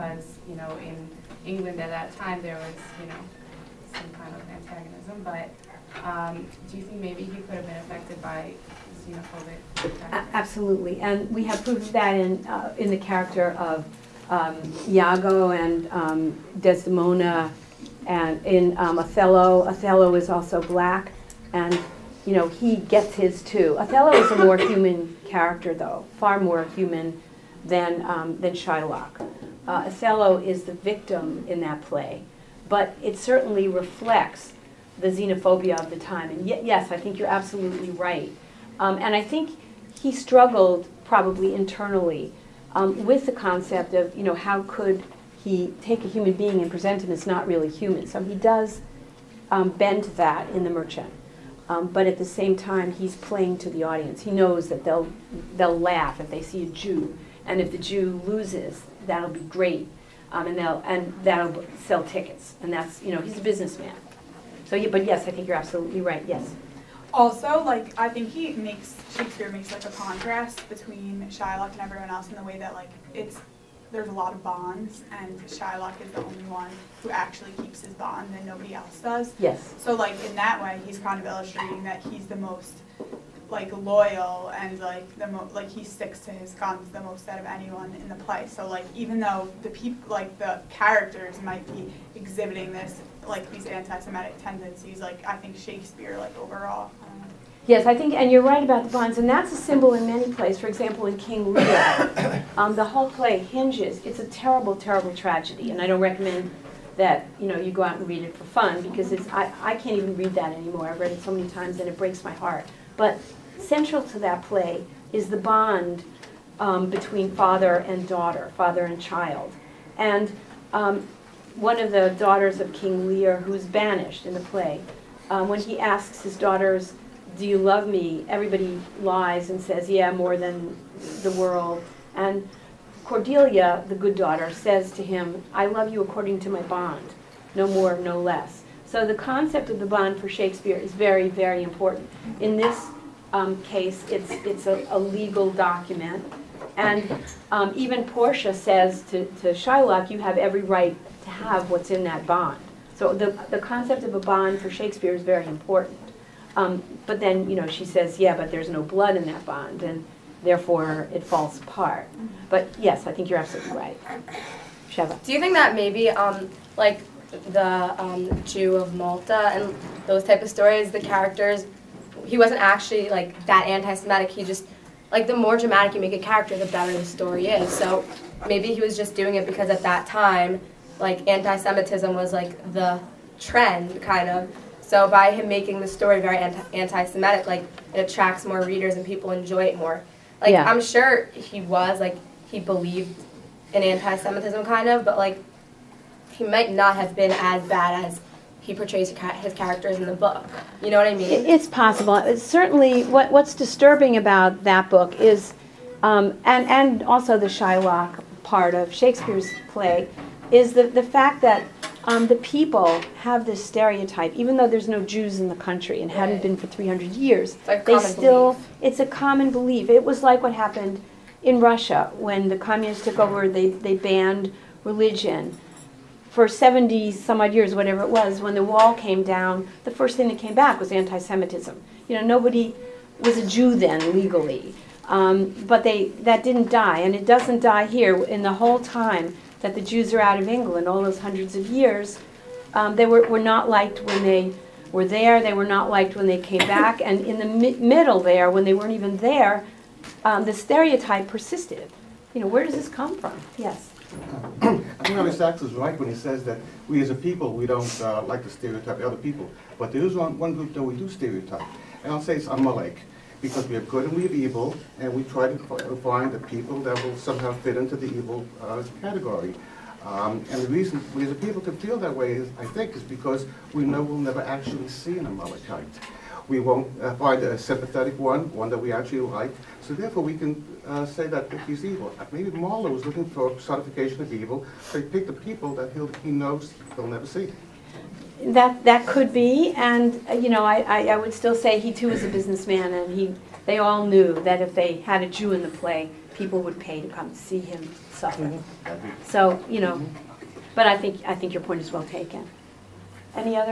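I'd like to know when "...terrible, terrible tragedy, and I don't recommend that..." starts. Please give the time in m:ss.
1:44.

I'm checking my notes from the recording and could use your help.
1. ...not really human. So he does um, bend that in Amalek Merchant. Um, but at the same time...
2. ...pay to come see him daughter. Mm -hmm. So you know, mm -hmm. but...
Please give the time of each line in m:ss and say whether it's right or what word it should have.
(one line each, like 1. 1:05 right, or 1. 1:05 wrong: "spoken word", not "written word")
1. 0:47 wrong: "The", not "Amalek"
2. 4:56 wrong: "suffer", not "daughter".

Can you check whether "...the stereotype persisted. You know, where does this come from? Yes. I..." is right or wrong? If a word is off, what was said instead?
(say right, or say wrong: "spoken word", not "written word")
right.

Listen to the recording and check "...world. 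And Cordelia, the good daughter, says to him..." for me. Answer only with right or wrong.
right.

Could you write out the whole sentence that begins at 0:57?
And if the Jew loses, that'll be great.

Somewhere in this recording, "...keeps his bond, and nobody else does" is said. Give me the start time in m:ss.
1:17.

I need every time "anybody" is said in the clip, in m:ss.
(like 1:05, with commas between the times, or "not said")
not said.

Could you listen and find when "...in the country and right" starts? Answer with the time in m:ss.
3:35.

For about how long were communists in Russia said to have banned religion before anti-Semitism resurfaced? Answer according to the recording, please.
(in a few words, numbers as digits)
70 some odd years.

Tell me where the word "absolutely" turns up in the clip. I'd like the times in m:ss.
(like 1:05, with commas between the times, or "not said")
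0:10, 0:37, 1:05, 2:43.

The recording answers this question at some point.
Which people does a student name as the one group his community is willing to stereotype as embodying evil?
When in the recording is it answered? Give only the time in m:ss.
4:22.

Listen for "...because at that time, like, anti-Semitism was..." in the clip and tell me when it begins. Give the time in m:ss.
2:59.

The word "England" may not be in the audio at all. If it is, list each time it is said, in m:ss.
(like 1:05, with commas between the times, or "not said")
0:01, 4:00.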